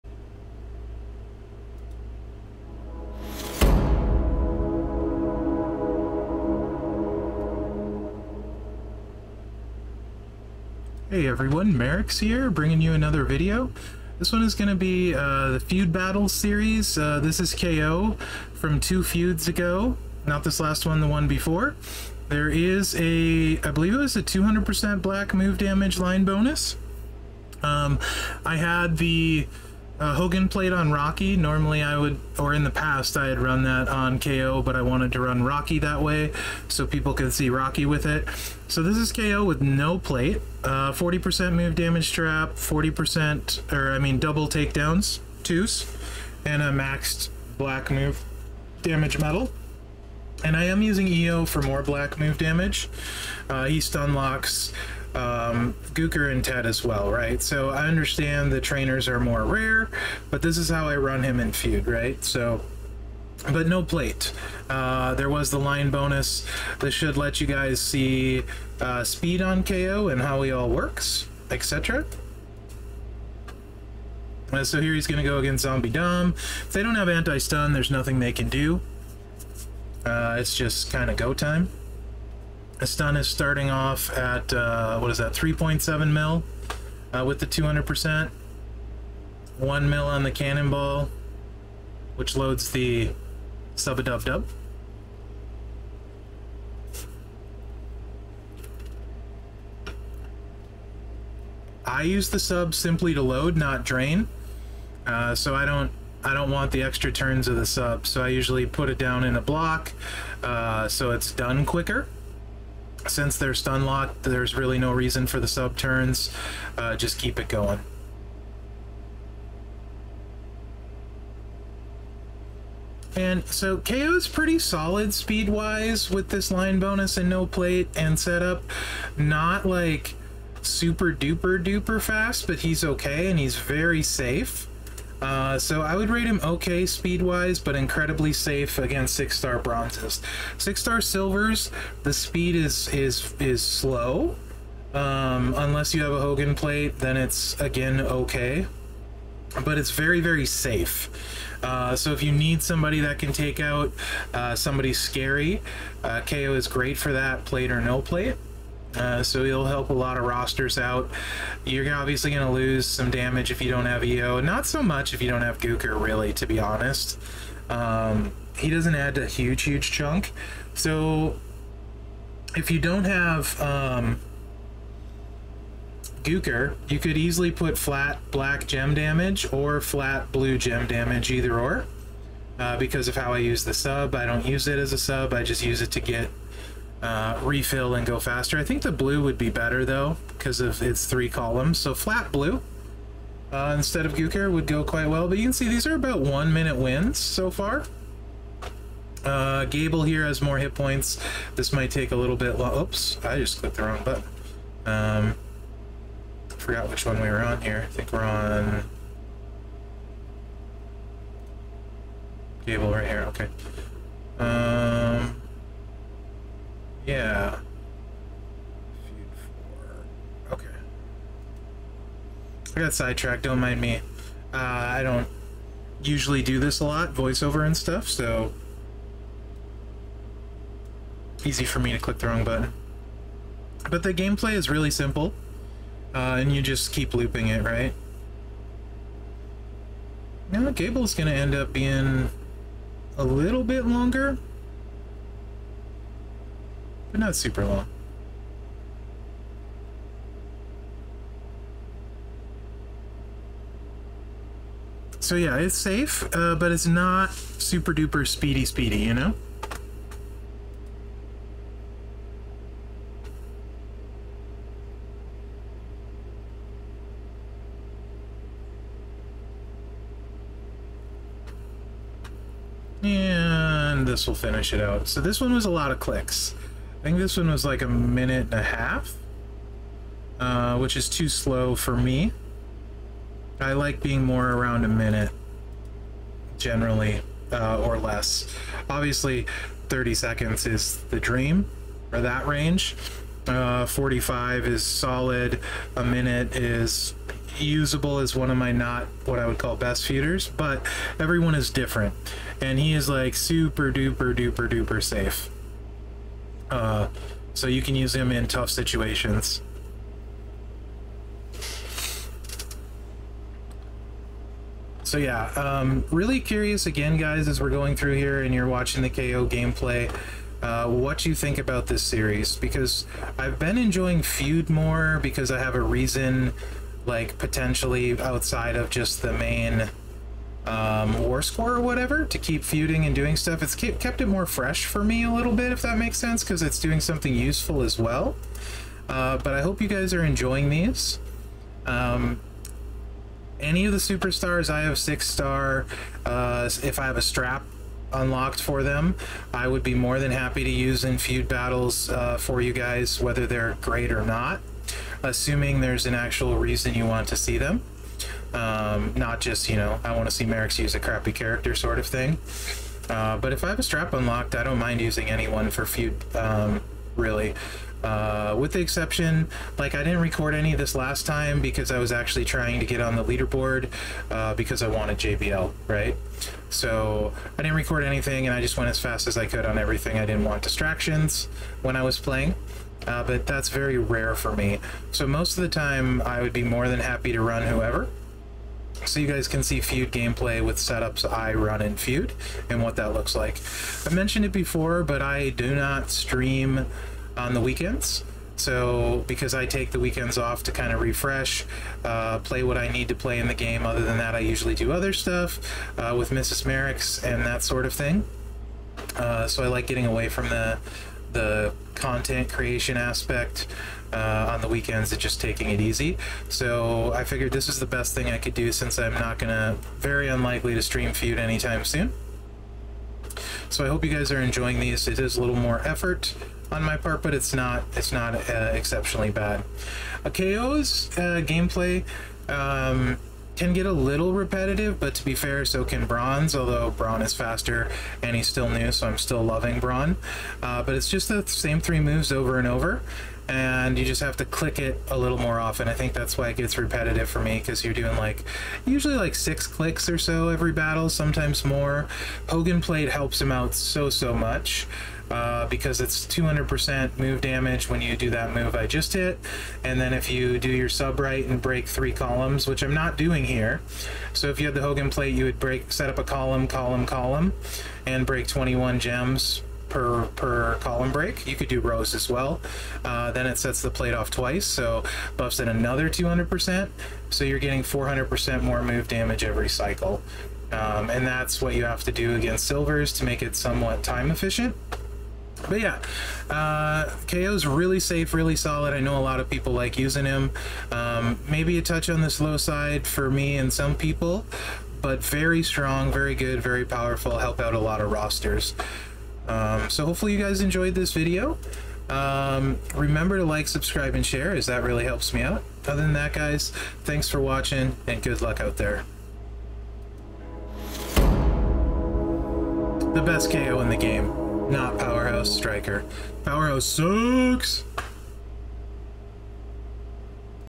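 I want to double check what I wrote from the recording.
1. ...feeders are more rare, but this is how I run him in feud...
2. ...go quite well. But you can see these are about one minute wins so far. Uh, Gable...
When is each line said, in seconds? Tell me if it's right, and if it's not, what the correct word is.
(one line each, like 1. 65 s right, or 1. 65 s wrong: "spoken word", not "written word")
1. 58 s wrong: "trainers", not "feeders"
2. 194 s right.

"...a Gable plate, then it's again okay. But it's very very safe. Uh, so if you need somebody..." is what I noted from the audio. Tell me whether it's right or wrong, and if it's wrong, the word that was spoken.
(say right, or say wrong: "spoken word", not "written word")
wrong: "Hogan", not "Gable".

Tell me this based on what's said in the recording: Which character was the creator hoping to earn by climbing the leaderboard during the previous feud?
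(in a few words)
JBL.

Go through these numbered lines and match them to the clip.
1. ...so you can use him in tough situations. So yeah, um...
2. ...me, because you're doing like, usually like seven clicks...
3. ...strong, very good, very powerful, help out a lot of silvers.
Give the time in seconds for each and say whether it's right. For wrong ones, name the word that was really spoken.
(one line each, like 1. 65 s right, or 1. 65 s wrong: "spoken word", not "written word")
1. 307 s right
2. 447 s wrong: "six", not "seven"
3. 495 s wrong: "rosters", not "silvers".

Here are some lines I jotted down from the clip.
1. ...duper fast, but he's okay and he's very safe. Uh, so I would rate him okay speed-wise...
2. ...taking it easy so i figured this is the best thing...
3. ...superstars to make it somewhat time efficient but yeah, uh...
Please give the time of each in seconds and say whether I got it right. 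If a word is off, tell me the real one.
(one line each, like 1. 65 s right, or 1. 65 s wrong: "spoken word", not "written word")
1. 131 s right
2. 415 s right
3. 482 s wrong: "silvers", not "superstars".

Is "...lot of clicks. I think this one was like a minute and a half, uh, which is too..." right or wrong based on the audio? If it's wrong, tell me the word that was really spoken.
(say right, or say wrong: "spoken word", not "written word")
right.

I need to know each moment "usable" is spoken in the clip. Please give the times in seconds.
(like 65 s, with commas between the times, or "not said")
297 s.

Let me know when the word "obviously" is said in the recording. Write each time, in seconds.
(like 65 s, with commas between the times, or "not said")
161 s, 288 s.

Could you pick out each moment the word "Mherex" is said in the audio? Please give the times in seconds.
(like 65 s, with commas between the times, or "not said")
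11 s, 360 s, 406 s.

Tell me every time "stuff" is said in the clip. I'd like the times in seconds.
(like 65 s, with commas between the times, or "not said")
227 s, 333 s, 405 s.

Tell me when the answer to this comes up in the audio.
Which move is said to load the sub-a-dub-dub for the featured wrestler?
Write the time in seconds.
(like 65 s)
90 s.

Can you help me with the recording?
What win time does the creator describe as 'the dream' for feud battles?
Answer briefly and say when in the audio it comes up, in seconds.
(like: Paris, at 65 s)
30 seconds, at 289 s.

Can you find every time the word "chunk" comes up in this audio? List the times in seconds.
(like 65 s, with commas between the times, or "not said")
169 s.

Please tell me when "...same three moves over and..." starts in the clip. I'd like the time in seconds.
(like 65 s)
441 s.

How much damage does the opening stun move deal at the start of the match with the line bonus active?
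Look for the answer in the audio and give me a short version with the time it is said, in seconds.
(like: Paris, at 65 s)
3.7 million, at 85 s.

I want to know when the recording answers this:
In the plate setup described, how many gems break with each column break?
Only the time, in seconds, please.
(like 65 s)
468 s.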